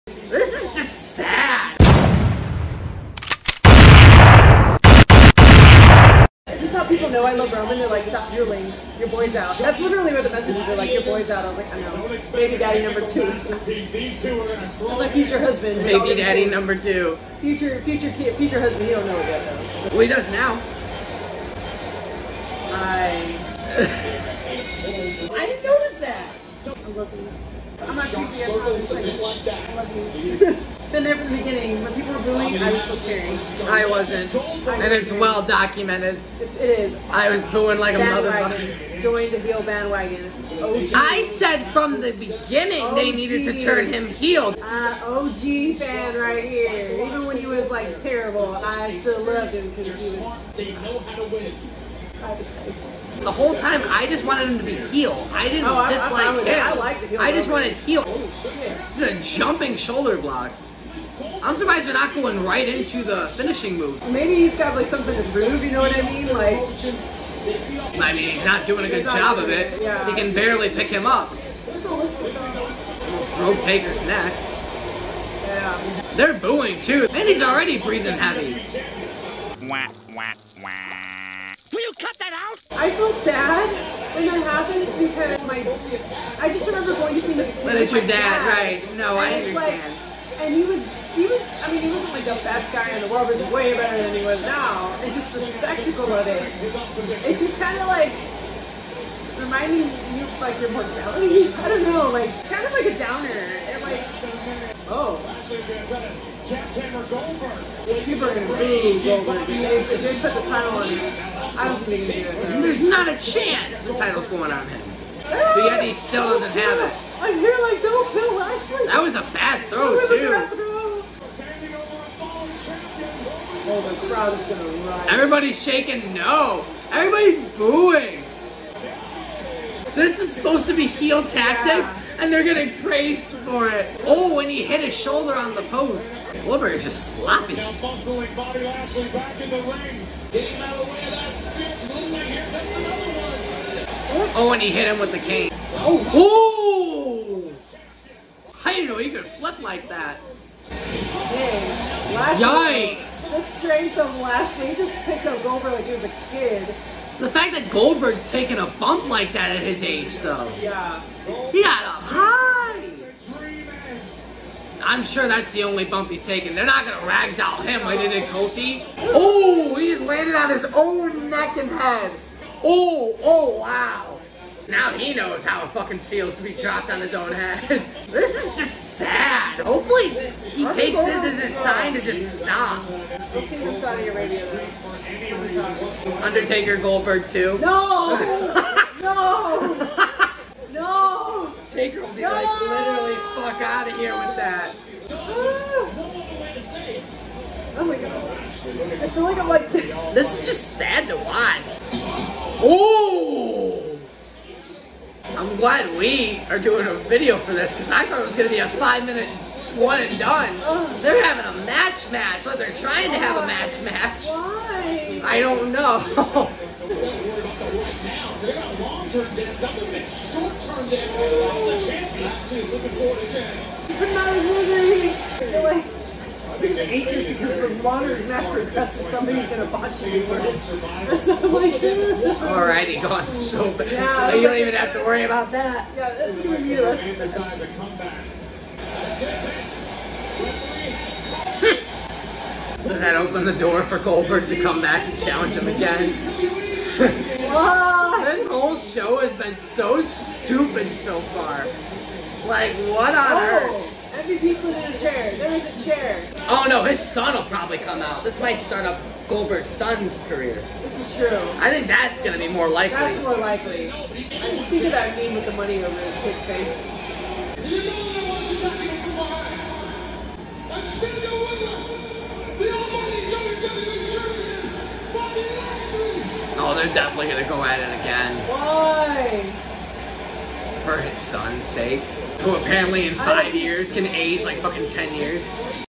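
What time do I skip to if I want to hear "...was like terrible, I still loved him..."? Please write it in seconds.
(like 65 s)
47 s.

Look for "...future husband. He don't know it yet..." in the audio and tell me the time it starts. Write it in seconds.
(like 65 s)
18 s.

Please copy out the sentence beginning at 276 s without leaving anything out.
they're definitely gonna go at it again.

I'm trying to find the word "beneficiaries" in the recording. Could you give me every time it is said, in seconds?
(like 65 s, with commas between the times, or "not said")
not said.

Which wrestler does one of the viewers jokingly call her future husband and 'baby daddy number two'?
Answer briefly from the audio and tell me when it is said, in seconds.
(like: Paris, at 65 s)
Roman, at 7 s.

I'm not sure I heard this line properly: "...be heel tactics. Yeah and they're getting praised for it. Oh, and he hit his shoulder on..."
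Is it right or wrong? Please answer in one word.
right.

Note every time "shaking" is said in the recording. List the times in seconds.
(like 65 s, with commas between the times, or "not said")
125 s.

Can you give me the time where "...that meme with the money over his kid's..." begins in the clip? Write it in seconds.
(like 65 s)
264 s.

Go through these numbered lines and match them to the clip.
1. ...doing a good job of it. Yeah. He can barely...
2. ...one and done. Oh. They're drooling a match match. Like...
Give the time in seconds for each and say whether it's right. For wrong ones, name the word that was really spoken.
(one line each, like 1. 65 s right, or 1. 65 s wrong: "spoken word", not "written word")
1. 68 s right
2. 209 s wrong: "having", not "drooling".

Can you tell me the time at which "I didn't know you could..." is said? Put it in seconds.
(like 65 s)
148 s.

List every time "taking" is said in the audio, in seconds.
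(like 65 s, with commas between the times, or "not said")
158 s, 166 s.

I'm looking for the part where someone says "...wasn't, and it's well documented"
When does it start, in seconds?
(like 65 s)
33 s.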